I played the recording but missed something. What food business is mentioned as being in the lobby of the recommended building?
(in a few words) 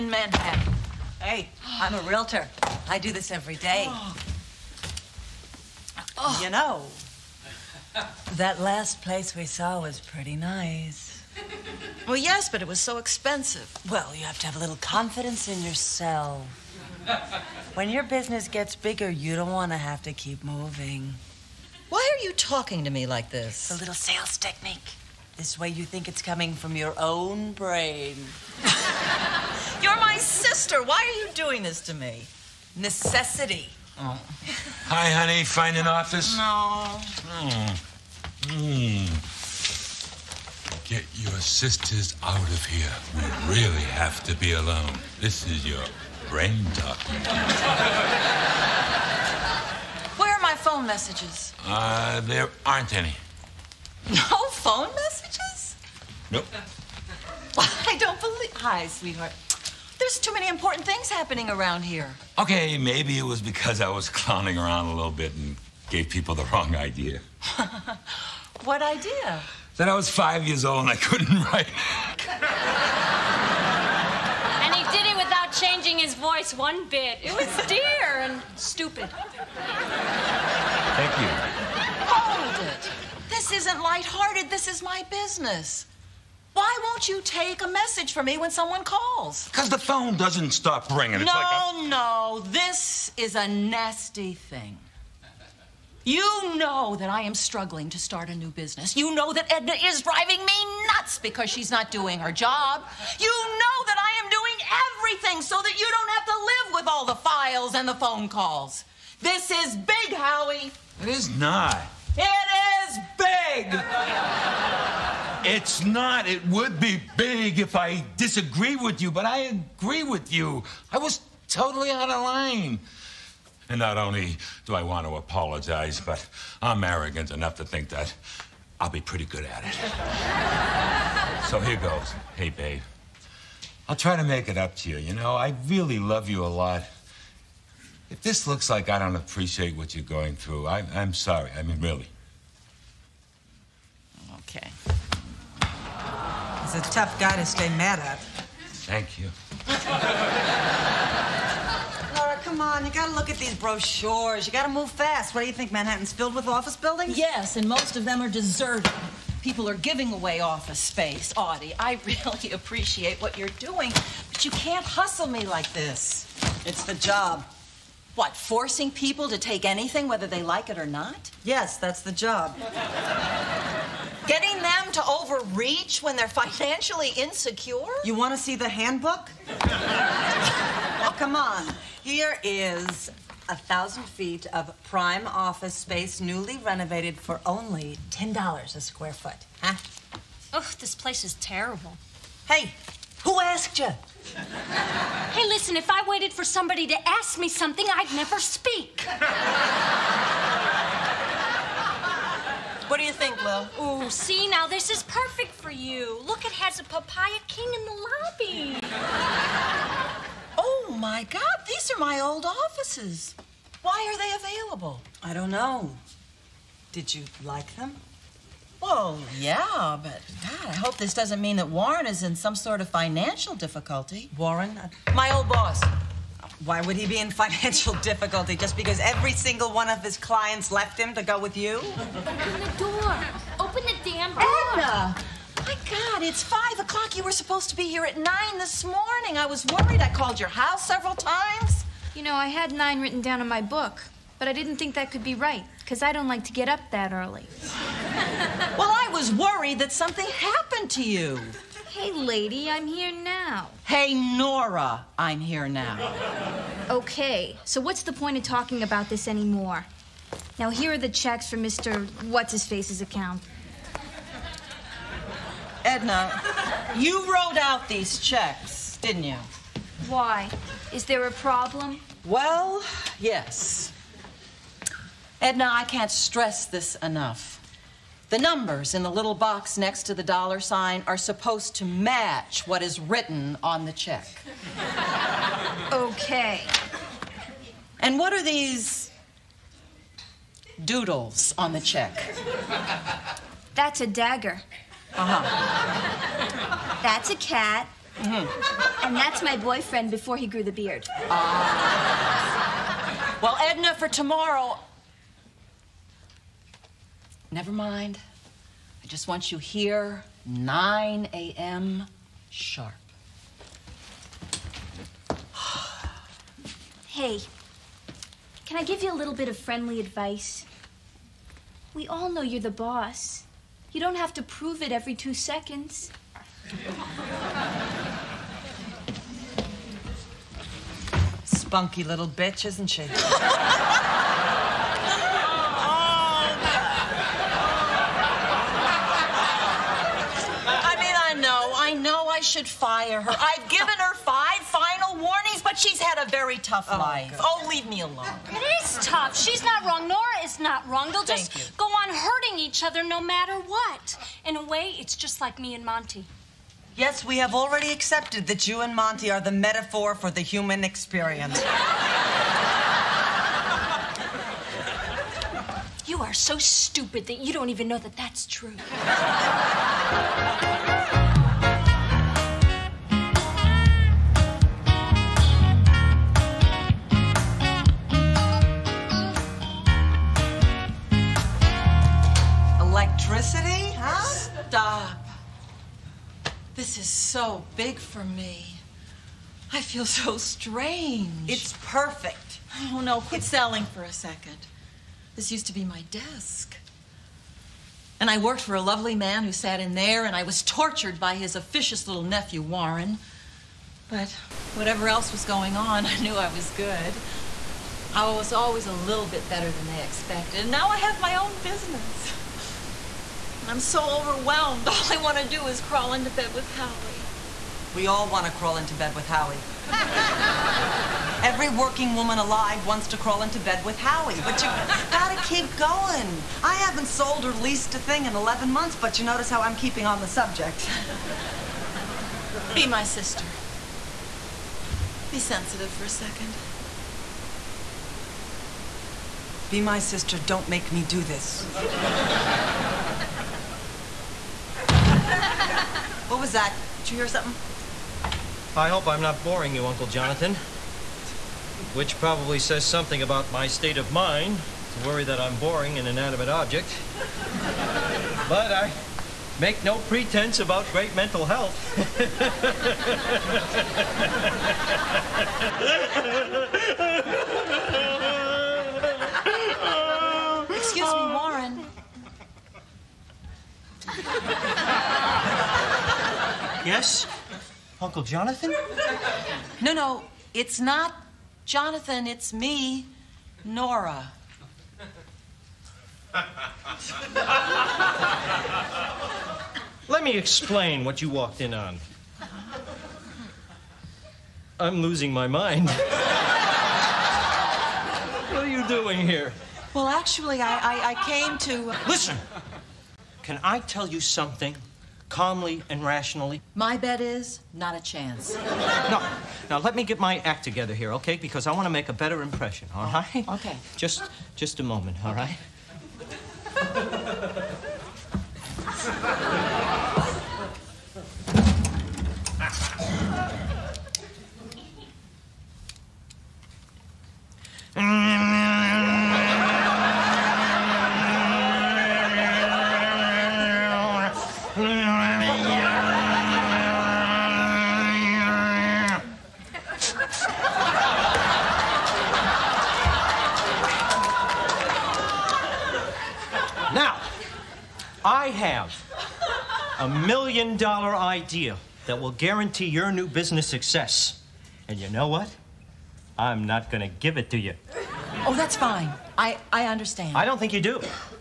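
Papaya King.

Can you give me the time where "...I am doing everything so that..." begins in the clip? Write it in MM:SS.
01:43.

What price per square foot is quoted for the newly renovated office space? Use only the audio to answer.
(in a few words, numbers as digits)
$10.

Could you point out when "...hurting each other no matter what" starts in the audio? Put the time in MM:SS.
05:52.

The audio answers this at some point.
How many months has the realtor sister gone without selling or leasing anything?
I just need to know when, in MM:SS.
07:08.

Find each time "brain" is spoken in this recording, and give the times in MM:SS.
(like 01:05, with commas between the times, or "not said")
00:27, 00:46.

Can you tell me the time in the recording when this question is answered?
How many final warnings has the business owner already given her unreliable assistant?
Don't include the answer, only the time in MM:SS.
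05:44.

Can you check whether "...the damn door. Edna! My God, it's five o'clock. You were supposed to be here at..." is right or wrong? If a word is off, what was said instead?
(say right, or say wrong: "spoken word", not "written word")
right.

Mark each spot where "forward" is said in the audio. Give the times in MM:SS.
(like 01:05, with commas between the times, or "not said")
not said.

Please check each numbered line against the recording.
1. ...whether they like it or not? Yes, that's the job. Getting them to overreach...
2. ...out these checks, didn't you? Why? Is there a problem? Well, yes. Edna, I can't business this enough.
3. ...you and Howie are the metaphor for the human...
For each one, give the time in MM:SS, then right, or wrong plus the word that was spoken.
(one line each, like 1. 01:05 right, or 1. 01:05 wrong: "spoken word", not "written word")
1. 02:50 right
2. 04:27 wrong: "stress", not "business"
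3. 05:58 wrong: "Monty", not "Howie".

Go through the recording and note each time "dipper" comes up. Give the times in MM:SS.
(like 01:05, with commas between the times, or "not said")
not said.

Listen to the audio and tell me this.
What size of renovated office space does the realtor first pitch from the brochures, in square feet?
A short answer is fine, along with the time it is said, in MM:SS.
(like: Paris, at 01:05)
1000, at 03:03.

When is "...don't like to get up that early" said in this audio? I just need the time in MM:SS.
04:06.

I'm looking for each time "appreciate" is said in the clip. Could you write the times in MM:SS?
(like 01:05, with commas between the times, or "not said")
02:19, 02:42.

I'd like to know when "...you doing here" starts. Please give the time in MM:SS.
08:18.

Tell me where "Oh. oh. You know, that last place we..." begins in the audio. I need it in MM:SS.
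00:03.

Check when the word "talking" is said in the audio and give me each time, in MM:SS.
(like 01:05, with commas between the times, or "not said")
00:22, 00:46, 04:18.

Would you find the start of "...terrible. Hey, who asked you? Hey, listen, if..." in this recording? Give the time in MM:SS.
03:11.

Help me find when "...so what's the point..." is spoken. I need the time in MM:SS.
04:17.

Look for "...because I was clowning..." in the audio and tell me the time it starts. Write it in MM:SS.
01:03.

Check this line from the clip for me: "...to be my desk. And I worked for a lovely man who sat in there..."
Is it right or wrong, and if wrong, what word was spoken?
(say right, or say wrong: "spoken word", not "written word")
right.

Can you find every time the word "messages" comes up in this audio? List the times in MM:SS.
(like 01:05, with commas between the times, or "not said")
00:50, 00:54, 01:27.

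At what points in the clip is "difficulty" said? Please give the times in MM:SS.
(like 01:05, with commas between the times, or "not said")
03:43, 03:47.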